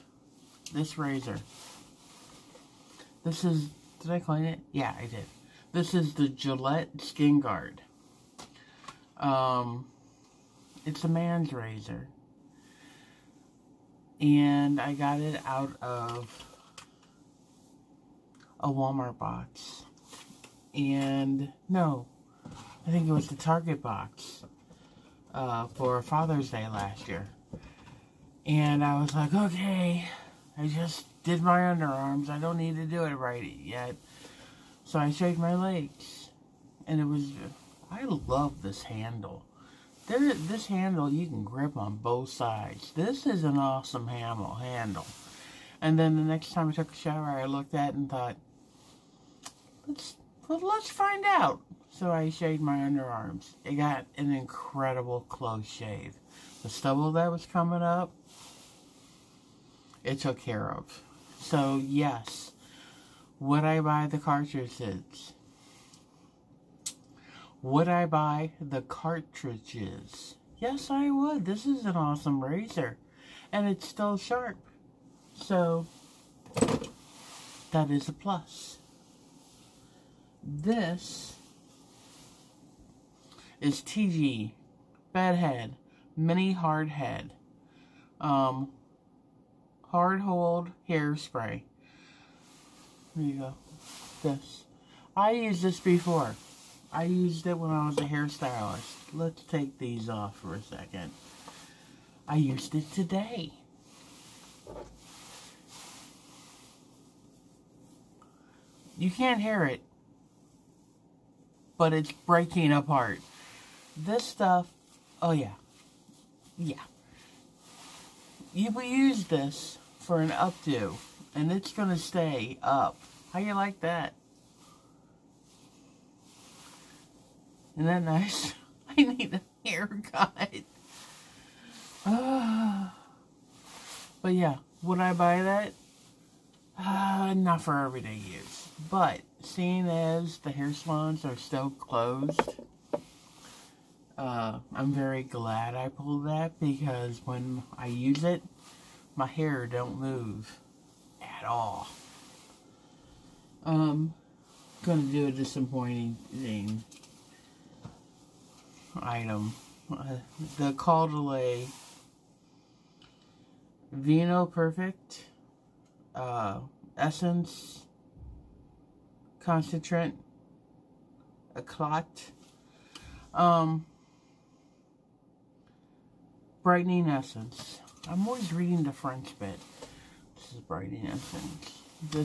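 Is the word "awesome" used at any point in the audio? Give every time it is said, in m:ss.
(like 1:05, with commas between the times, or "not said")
0:43, 1:11.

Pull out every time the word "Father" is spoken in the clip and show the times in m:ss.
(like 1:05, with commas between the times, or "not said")
0:26.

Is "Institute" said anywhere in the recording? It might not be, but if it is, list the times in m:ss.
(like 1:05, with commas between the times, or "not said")
not said.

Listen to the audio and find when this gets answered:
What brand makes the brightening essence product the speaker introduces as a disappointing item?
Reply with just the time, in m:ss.
2:40.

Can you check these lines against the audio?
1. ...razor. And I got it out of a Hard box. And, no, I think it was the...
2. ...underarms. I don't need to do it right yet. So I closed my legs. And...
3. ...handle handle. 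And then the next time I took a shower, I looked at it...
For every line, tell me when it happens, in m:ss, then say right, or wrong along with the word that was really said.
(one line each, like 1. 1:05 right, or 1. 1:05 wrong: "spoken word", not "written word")
1. 0:11 wrong: "Walmart", not "Hard"
2. 0:31 wrong: "shaved", not "closed"
3. 0:44 right.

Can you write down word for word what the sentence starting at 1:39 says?
Let's take these off for a second.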